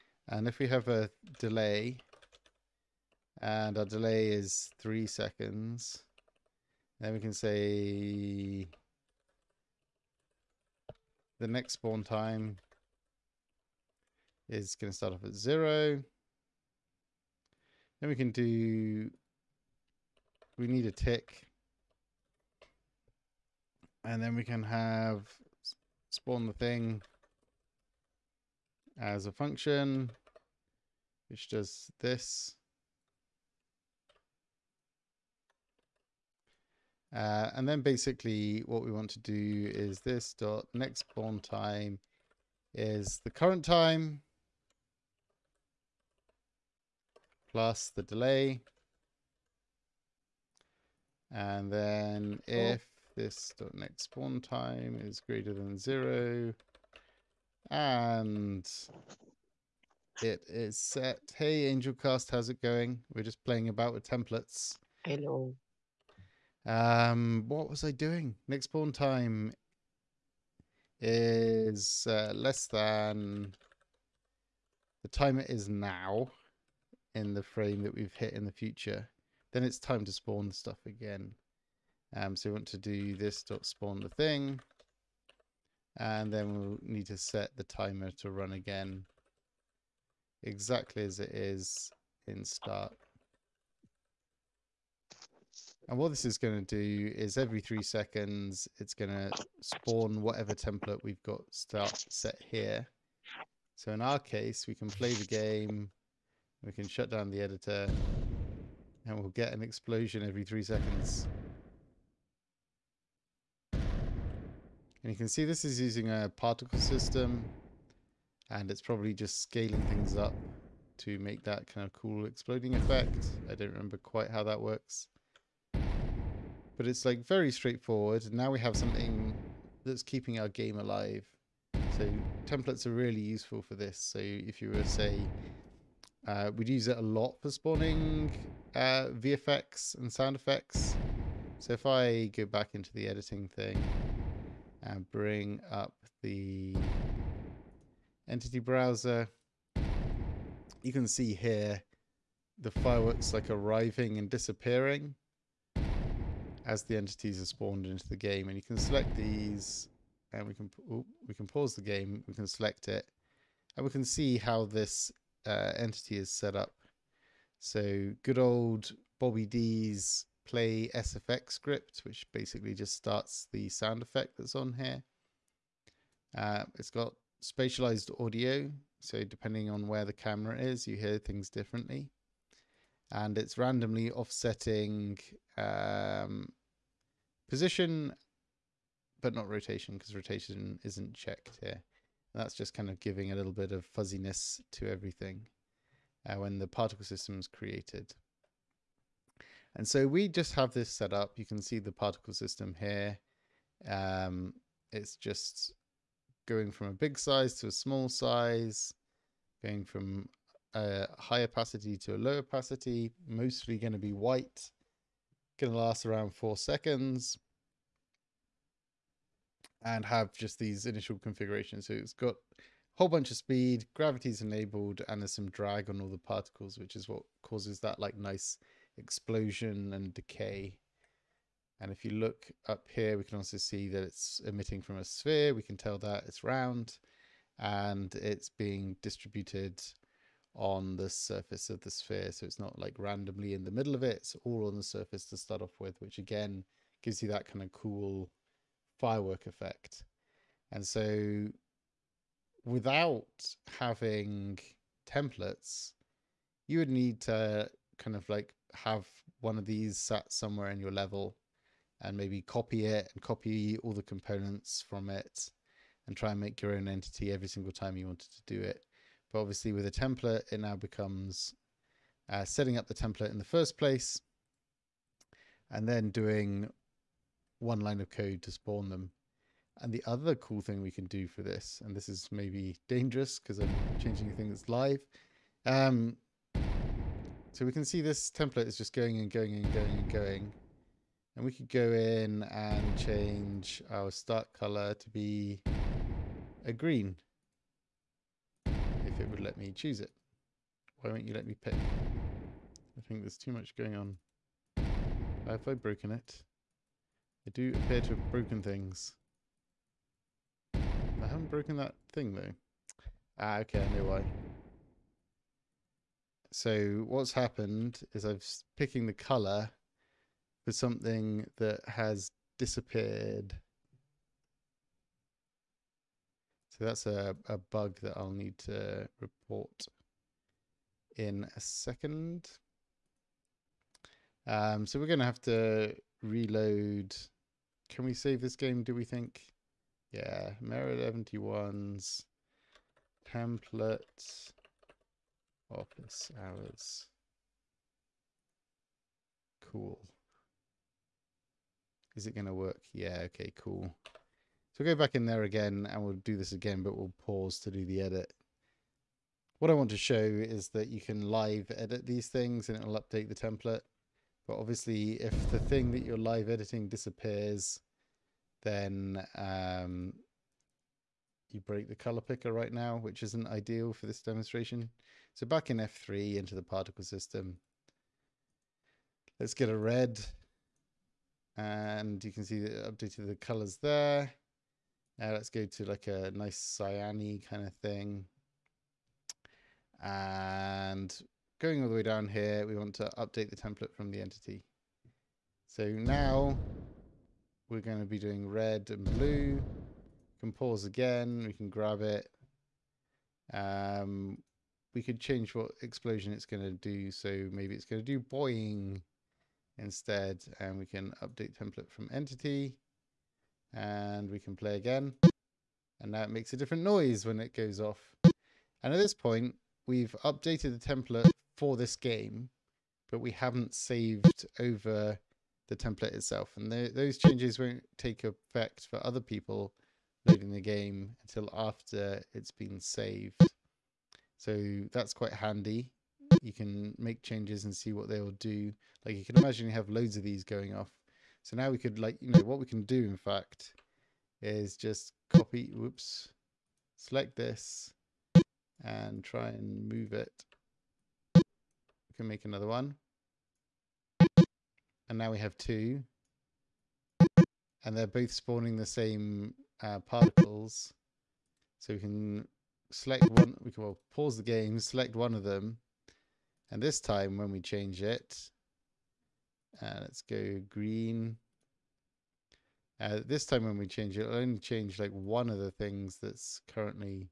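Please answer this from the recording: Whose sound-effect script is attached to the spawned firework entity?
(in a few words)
Bobby D.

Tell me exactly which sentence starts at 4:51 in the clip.
And we could go in and change our start color to be a green.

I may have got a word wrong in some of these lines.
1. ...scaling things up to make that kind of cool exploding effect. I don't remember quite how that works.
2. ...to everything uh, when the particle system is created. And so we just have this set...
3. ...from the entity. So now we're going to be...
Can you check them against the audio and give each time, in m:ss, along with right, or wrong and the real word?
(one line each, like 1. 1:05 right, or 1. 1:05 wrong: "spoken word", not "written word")
1. 1:59 right
2. 3:14 right
3. 6:33 right.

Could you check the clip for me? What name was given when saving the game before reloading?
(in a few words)
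Mirror 71's templates.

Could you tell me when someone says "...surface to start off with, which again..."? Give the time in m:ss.
4:04.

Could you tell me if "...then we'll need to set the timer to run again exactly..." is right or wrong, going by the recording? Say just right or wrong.
right.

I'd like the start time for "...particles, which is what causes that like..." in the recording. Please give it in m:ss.
3:46.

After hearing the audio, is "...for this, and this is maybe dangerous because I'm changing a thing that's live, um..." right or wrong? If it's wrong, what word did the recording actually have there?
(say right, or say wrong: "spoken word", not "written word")
right.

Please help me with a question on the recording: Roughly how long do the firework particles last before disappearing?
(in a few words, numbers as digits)
4 seconds.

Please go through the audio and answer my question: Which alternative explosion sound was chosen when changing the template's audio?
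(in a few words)
Boing.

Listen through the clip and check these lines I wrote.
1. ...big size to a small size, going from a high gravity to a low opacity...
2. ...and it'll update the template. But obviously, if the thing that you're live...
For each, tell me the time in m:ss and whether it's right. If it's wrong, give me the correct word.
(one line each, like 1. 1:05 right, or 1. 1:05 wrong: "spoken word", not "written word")
1. 3:26 wrong: "opacity", not "gravity"
2. 6:02 right.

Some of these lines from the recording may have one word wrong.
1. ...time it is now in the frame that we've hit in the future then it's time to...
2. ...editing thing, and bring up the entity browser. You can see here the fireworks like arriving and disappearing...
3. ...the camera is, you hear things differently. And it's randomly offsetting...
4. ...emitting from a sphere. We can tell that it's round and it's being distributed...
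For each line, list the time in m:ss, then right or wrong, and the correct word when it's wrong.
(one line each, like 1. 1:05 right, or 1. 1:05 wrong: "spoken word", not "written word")
1. 1:15 right
2. 2:23 right
3. 3:00 right
4. 3:54 right.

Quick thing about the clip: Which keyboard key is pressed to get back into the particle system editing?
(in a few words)
F3.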